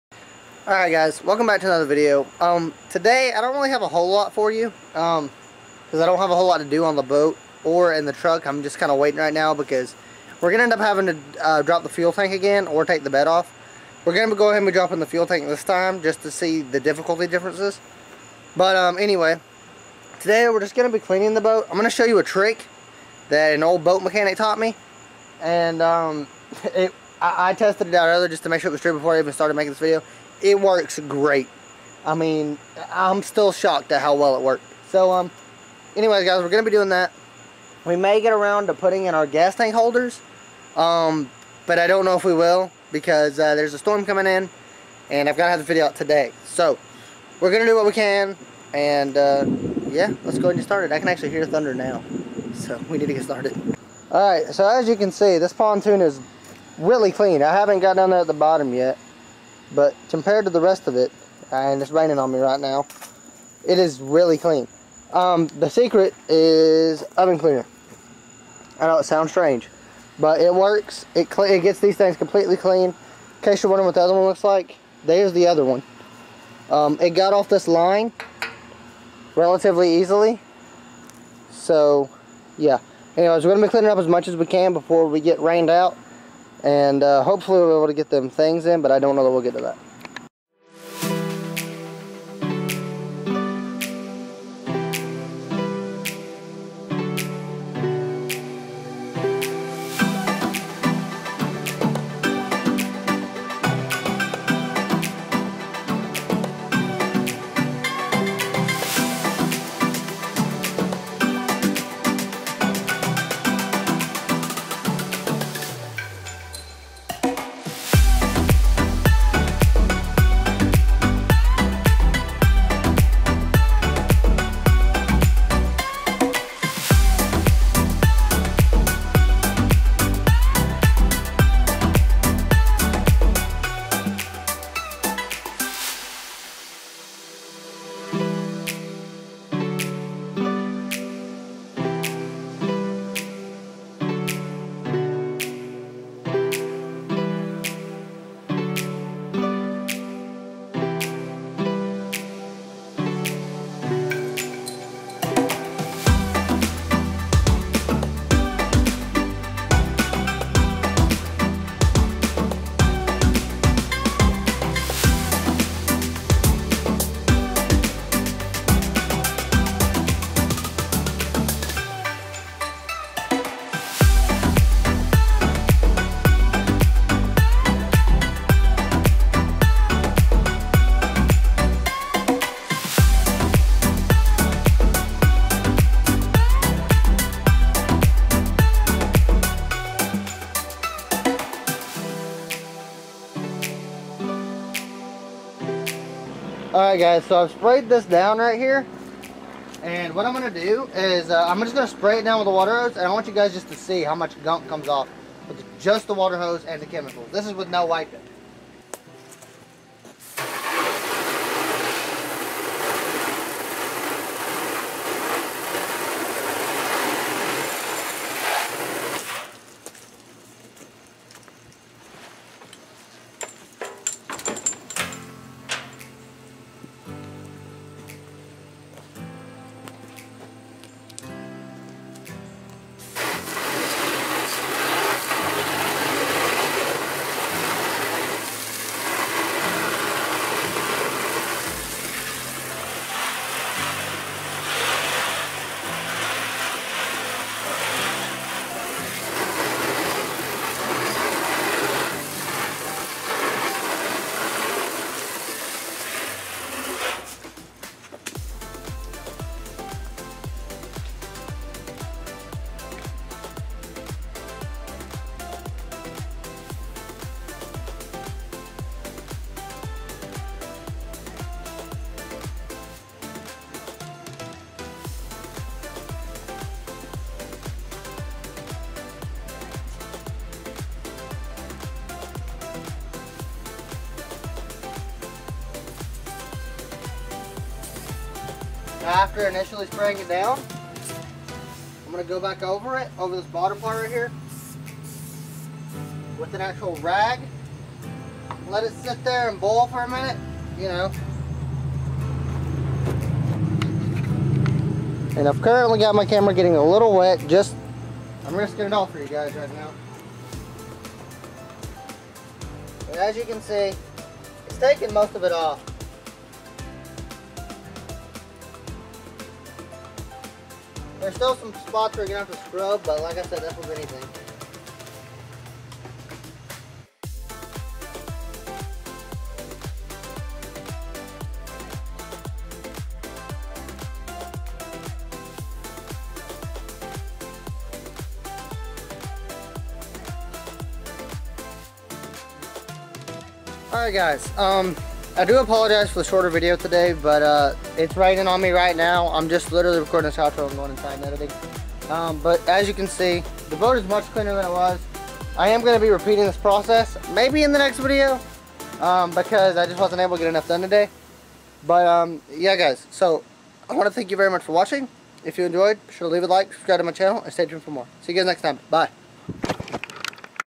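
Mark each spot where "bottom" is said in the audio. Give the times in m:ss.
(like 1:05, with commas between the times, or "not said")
0:58, 4:53.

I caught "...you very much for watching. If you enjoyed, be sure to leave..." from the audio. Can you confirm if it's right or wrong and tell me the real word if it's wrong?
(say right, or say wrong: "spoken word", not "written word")
right.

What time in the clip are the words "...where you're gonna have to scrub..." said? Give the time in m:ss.
5:22.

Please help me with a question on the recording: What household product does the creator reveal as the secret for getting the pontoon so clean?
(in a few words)
oven cleaner.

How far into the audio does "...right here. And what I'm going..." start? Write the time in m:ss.
3:18.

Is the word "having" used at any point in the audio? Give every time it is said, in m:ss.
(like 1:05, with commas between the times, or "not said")
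0:10.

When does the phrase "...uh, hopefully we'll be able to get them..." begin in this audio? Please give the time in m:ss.
1:27.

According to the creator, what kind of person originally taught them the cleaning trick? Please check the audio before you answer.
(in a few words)
old boat mechanic.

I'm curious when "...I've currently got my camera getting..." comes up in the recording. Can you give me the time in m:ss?
5:05.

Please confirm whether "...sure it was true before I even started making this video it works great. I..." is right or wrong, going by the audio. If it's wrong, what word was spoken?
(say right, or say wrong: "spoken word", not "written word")
right.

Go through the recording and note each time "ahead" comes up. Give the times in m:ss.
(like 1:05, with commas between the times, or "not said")
0:14, 0:50.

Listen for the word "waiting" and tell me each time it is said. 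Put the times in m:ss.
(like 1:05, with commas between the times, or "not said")
0:08.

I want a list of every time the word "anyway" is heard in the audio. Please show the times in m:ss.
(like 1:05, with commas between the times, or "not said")
0:18, 0:35, 1:23.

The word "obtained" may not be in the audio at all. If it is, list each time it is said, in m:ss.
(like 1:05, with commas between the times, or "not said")
not said.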